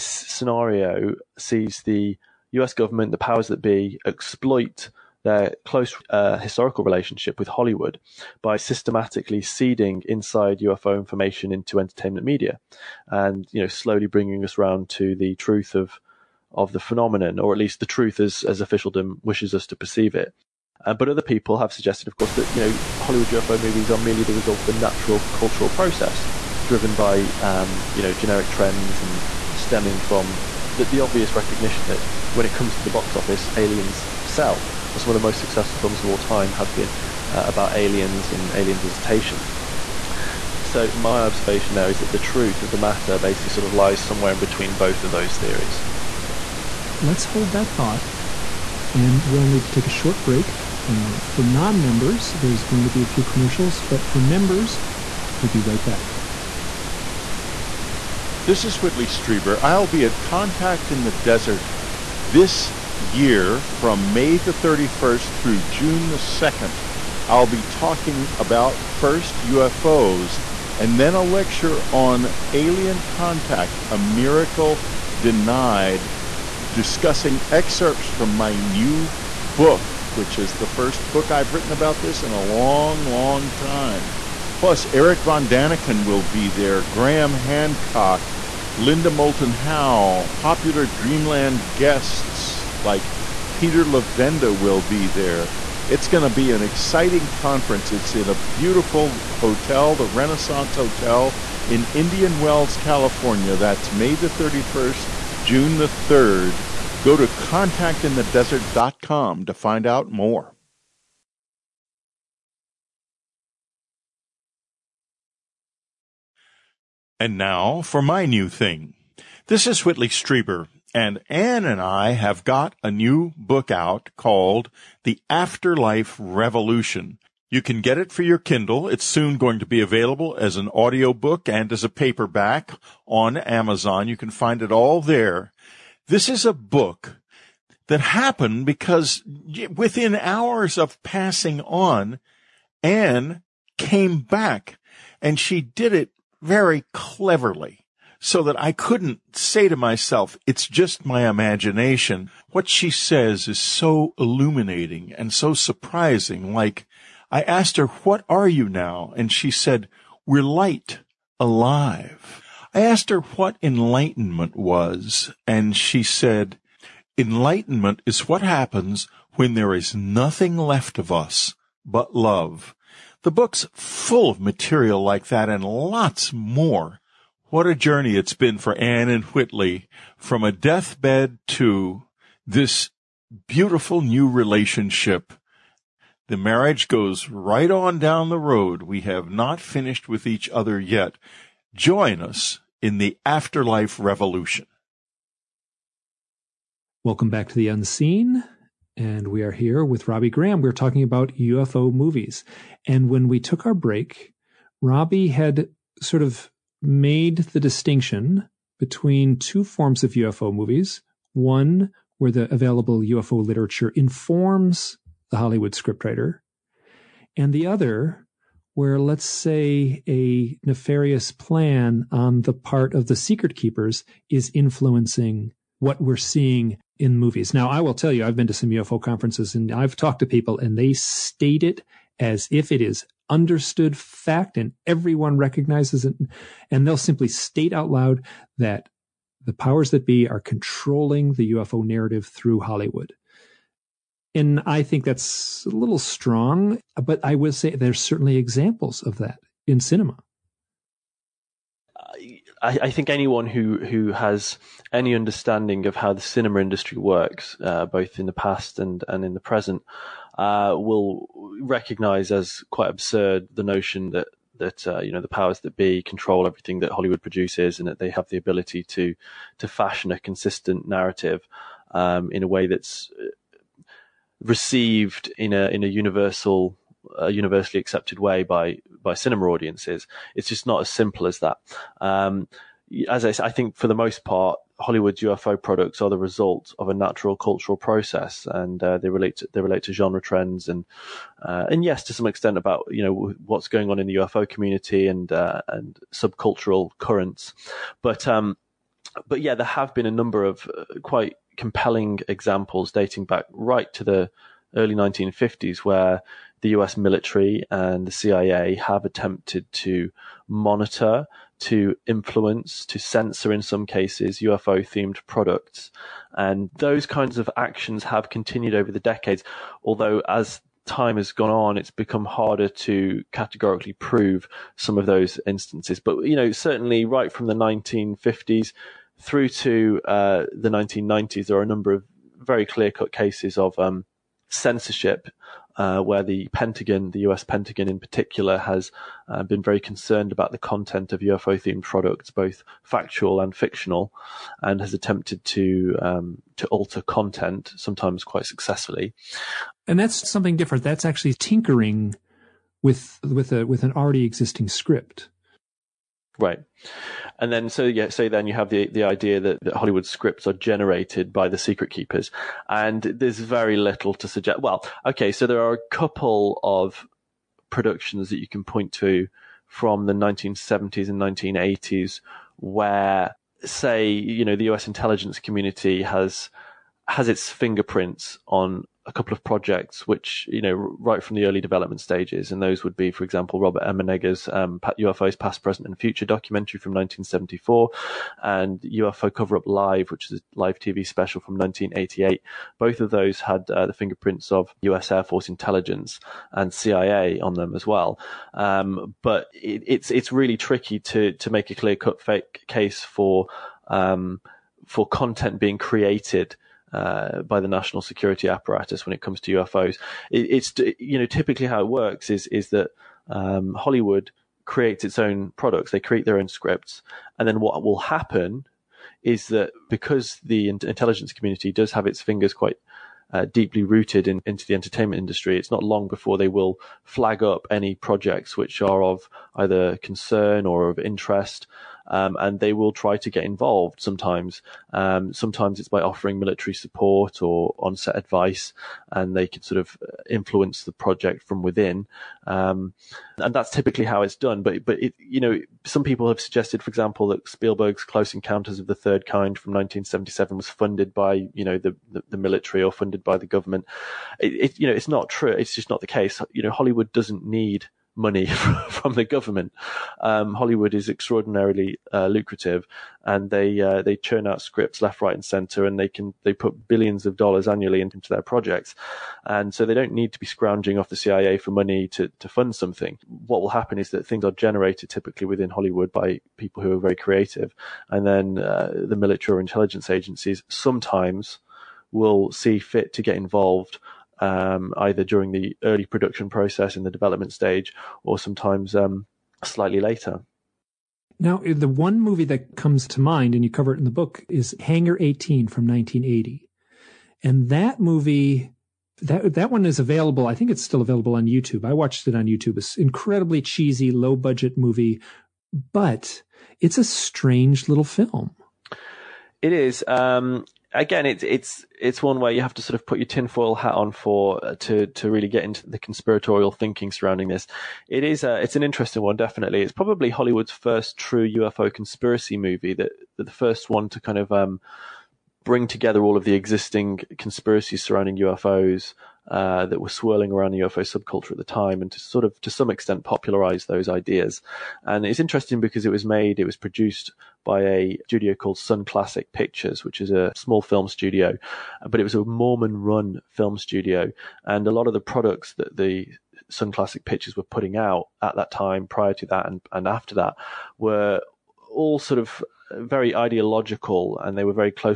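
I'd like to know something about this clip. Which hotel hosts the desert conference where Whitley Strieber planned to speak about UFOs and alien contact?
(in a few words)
Renaissance Hotel.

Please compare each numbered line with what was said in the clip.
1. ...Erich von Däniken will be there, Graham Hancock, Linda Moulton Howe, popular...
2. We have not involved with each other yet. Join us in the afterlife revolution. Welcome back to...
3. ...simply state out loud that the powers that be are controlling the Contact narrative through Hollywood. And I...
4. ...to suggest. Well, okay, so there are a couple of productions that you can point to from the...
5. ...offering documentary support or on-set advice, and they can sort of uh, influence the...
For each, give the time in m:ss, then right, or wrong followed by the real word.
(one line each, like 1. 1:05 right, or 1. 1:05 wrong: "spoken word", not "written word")
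1. 1:24 right
2. 3:08 wrong: "finished", not "involved"
3. 3:56 wrong: "UFO", not "Contact"
4. 6:04 right
5. 7:16 wrong: "military", not "documentary".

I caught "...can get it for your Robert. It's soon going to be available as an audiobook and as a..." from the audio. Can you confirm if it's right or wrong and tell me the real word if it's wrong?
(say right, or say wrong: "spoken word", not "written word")
wrong: "Kindle", not "Robert".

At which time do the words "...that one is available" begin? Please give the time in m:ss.
8:19.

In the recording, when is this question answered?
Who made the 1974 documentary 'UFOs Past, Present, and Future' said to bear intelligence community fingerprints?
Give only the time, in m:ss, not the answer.
6:23.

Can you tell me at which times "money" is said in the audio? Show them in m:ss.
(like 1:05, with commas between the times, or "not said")
7:38, 7:51.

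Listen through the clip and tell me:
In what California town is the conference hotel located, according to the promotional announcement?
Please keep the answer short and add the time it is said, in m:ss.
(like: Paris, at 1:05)
Indian Wells, at 1:41.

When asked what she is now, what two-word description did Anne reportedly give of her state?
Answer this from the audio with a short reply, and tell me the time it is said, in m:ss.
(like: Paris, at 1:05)
light, alive, at 2:40.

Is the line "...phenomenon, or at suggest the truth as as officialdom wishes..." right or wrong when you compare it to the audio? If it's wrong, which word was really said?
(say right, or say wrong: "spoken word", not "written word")
wrong: "least", not "suggest".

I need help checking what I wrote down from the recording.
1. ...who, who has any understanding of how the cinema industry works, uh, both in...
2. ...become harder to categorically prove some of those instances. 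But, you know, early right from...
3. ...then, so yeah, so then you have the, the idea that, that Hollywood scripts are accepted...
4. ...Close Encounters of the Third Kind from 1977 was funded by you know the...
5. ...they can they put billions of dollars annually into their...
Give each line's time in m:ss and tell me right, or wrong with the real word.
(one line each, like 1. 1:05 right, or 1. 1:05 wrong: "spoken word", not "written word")
1. 4:13 right
2. 5:21 wrong: "certainly", not "early"
3. 5:57 wrong: "generated", not "accepted"
4. 7:28 right
5. 7:45 right.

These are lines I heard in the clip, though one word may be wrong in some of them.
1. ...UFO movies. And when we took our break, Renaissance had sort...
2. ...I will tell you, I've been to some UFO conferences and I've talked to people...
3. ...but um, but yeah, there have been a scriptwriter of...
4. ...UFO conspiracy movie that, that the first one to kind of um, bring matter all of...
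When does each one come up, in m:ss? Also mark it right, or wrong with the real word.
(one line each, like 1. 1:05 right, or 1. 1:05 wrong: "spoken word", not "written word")
1. 3:21 wrong: "Robbie", not "Renaissance"
2. 3:47 right
3. 4:58 wrong: "number", not "scriptwriter"
4. 8:41 wrong: "together", not "matter".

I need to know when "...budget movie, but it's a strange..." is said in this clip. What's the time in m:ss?
8:24.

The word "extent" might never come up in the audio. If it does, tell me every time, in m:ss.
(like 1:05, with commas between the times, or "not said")
4:52, 8:52.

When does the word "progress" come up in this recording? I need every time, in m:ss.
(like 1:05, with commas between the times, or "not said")
not said.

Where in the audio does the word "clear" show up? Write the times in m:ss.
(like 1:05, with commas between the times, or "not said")
5:32, 6:41.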